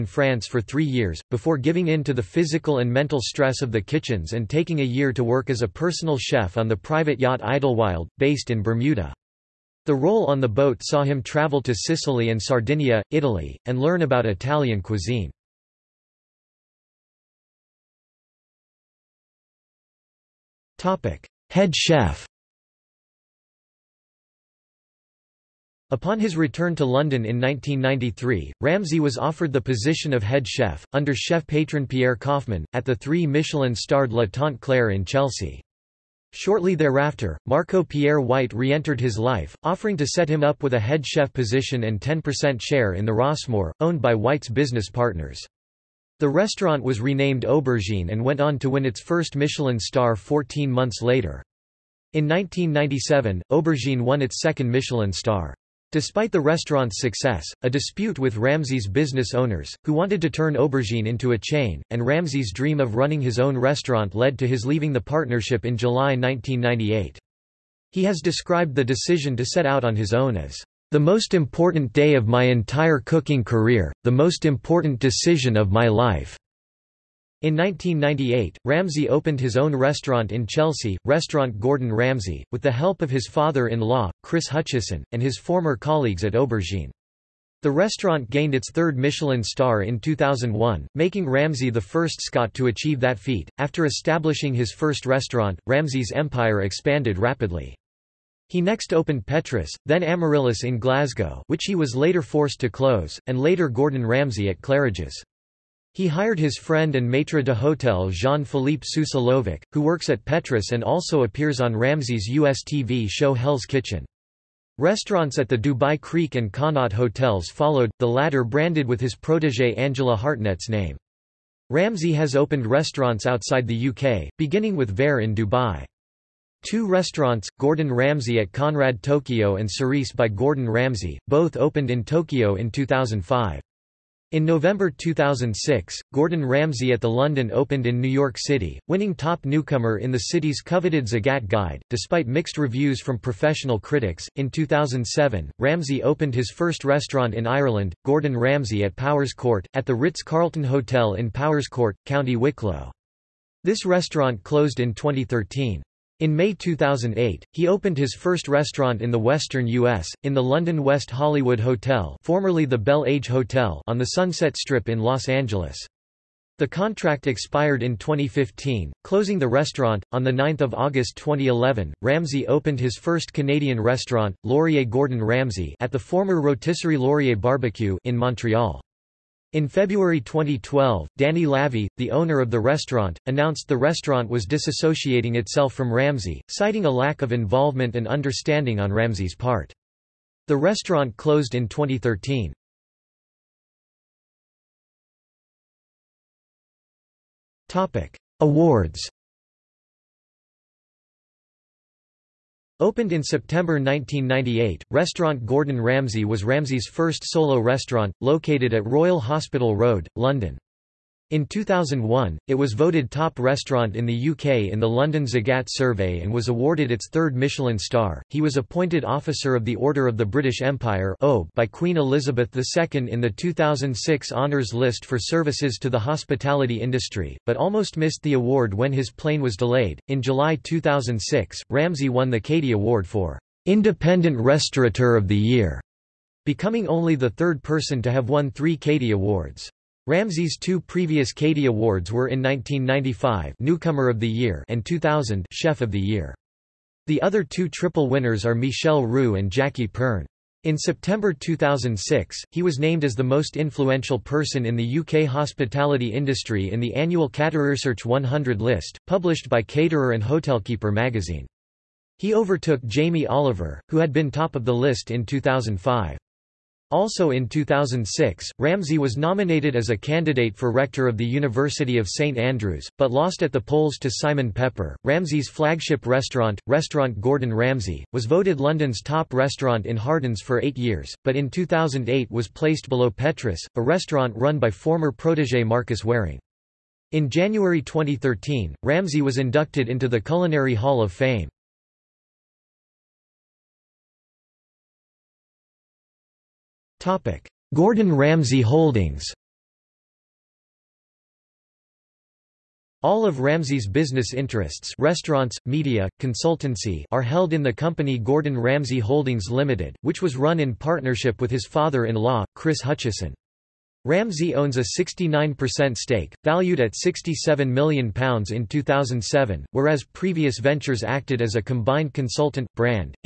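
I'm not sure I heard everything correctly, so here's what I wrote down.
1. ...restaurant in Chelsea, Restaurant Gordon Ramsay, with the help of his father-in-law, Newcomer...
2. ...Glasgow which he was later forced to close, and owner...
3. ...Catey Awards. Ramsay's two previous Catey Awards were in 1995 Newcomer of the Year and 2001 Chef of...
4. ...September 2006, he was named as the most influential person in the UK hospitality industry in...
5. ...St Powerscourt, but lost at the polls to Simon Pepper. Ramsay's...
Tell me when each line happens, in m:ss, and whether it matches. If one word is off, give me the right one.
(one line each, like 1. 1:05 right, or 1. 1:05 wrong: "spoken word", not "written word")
1. 1:19 wrong: "Chris", not "Newcomer"
2. 1:40 wrong: "later", not "owner"
3. 3:58 wrong: "2000", not "2001"
4. 4:10 right
5. 4:32 wrong: "Andrews", not "Powerscourt".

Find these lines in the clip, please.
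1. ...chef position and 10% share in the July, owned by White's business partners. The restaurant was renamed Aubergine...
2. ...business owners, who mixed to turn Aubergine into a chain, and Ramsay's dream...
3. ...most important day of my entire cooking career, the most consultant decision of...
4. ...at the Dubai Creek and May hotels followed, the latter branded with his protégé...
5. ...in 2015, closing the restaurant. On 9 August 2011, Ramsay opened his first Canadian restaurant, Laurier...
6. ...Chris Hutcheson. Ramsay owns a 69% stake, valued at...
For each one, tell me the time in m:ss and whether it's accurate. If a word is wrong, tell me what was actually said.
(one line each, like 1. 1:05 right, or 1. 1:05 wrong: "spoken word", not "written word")
1. 0:41 wrong: "Rossmore", not "July"
2. 0:58 wrong: "wanted", not "mixed"
3. 1:10 wrong: "important", not "consultant"
4. 1:55 wrong: "Connaught", not "May"
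5. 2:47 right
6. 5:12 right.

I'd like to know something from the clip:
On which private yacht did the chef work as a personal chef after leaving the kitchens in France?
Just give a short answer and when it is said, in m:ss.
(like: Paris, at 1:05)
Idlewild, at 0:07.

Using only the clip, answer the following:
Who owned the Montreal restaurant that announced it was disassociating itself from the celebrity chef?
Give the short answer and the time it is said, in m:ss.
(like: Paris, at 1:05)
Danny Lavey, at 3:01.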